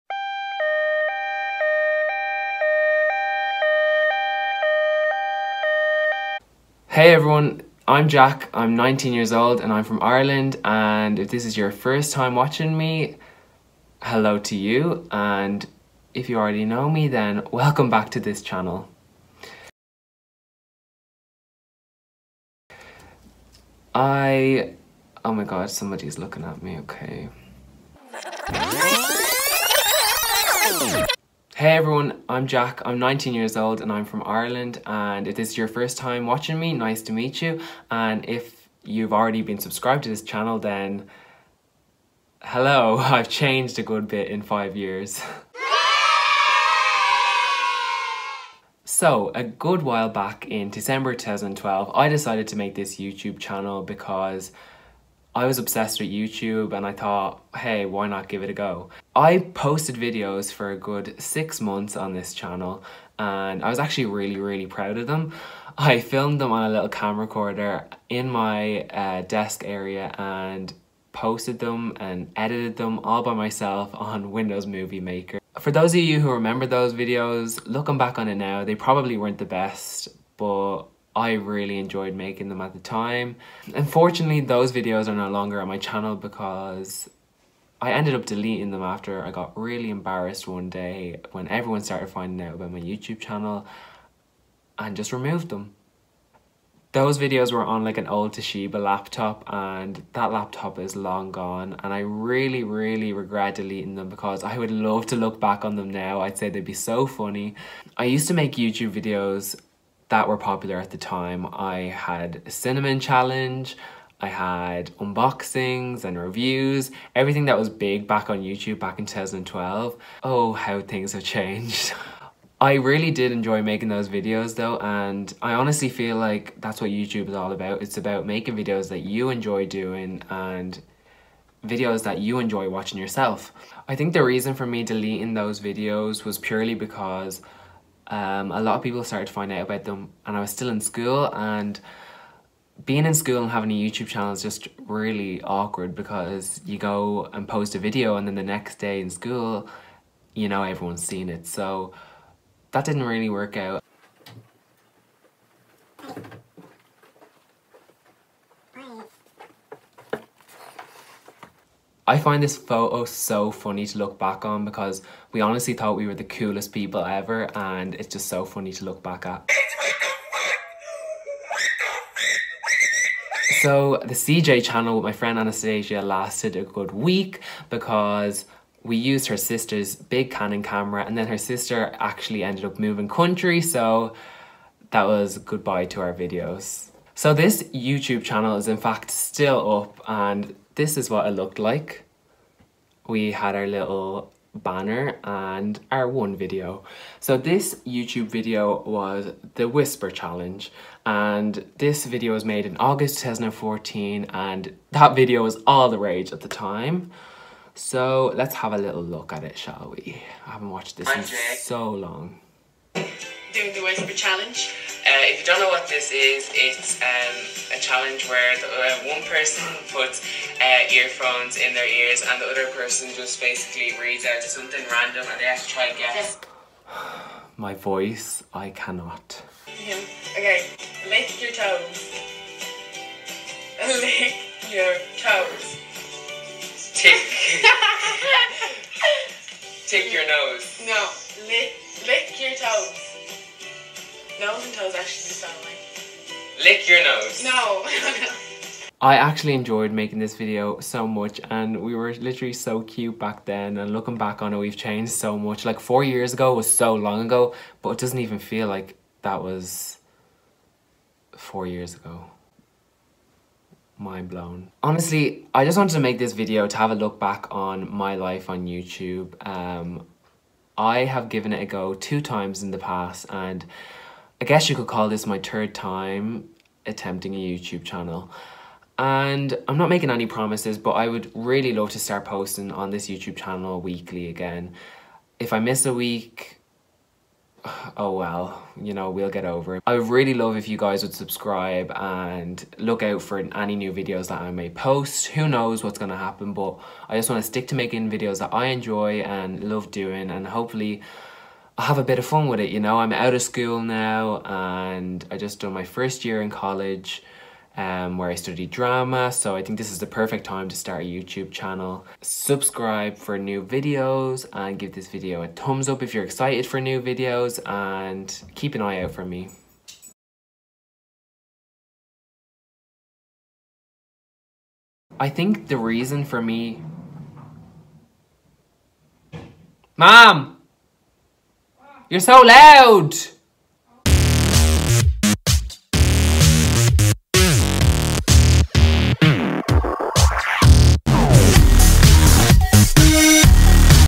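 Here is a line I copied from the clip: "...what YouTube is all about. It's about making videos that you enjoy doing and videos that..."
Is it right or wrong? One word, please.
right.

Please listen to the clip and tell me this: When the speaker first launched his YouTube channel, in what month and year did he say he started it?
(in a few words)
December 2012.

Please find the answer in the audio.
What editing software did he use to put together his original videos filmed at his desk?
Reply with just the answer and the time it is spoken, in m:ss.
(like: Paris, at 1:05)
Windows Movie Maker, at 1:14.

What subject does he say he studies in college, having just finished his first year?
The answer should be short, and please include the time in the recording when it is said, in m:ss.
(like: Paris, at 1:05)
Drama, at 5:08.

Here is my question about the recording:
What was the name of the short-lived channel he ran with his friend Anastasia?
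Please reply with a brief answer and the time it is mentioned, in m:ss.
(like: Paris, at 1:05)
CeeJay, at 2:54.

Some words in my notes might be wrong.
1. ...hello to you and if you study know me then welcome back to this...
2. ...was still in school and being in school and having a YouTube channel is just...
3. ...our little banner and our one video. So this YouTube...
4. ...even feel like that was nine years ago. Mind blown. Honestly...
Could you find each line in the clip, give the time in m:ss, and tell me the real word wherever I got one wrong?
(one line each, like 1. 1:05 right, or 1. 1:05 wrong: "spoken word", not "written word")
1. 0:14 wrong: "already", not "study"
2. 2:20 right
3. 3:13 right
4. 4:18 wrong: "four", not "nine".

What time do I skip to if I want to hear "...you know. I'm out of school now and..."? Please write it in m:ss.
5:02.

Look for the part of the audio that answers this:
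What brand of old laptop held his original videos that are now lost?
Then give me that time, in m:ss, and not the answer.
1:38.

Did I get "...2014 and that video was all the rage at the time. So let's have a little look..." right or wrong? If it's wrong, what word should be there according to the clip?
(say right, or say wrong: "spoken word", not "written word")
right.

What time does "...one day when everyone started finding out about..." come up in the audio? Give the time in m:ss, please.
1:30.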